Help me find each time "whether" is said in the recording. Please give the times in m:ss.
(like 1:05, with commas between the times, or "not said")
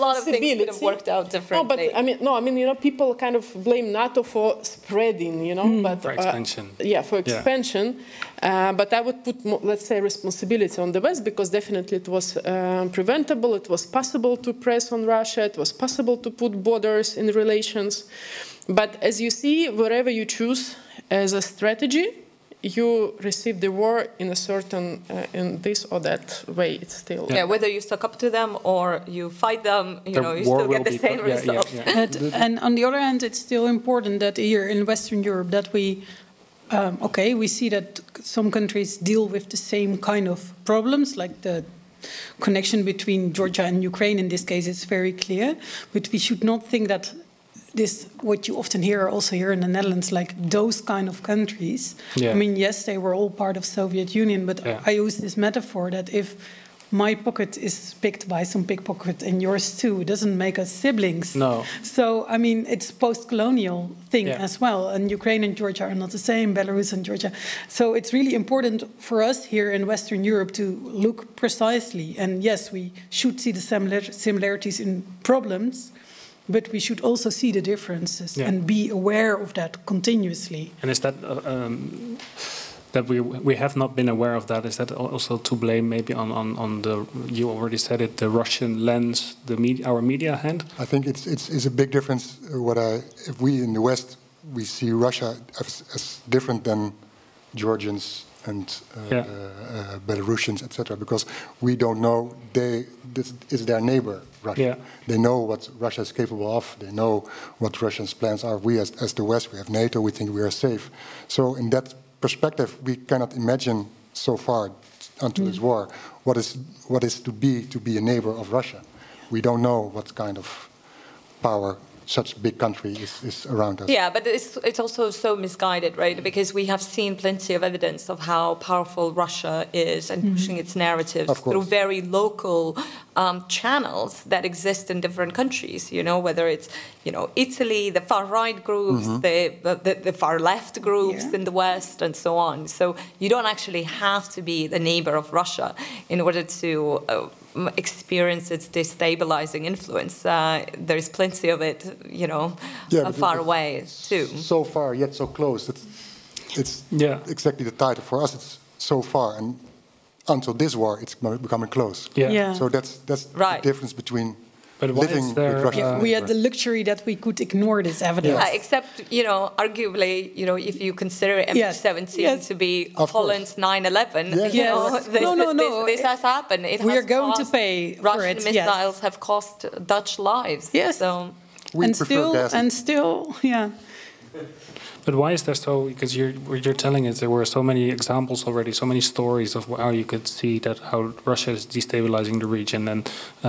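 0:27, 2:16.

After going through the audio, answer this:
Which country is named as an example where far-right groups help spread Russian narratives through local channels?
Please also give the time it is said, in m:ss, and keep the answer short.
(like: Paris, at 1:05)
Italy, at 2:17.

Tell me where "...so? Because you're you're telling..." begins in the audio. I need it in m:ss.
3:05.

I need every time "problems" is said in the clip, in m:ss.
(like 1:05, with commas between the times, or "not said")
0:40, 1:15.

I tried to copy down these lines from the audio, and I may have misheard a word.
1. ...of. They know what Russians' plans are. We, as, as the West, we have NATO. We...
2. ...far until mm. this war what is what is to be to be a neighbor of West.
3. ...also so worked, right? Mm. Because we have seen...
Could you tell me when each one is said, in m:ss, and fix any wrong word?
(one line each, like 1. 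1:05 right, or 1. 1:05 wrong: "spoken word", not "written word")
1. 1:46 right
2. 1:54 wrong: "Russia", not "West"
3. 2:04 wrong: "misguided", not "worked".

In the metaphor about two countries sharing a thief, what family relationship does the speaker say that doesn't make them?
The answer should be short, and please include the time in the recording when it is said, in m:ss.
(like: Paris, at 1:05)
siblings, at 1:00.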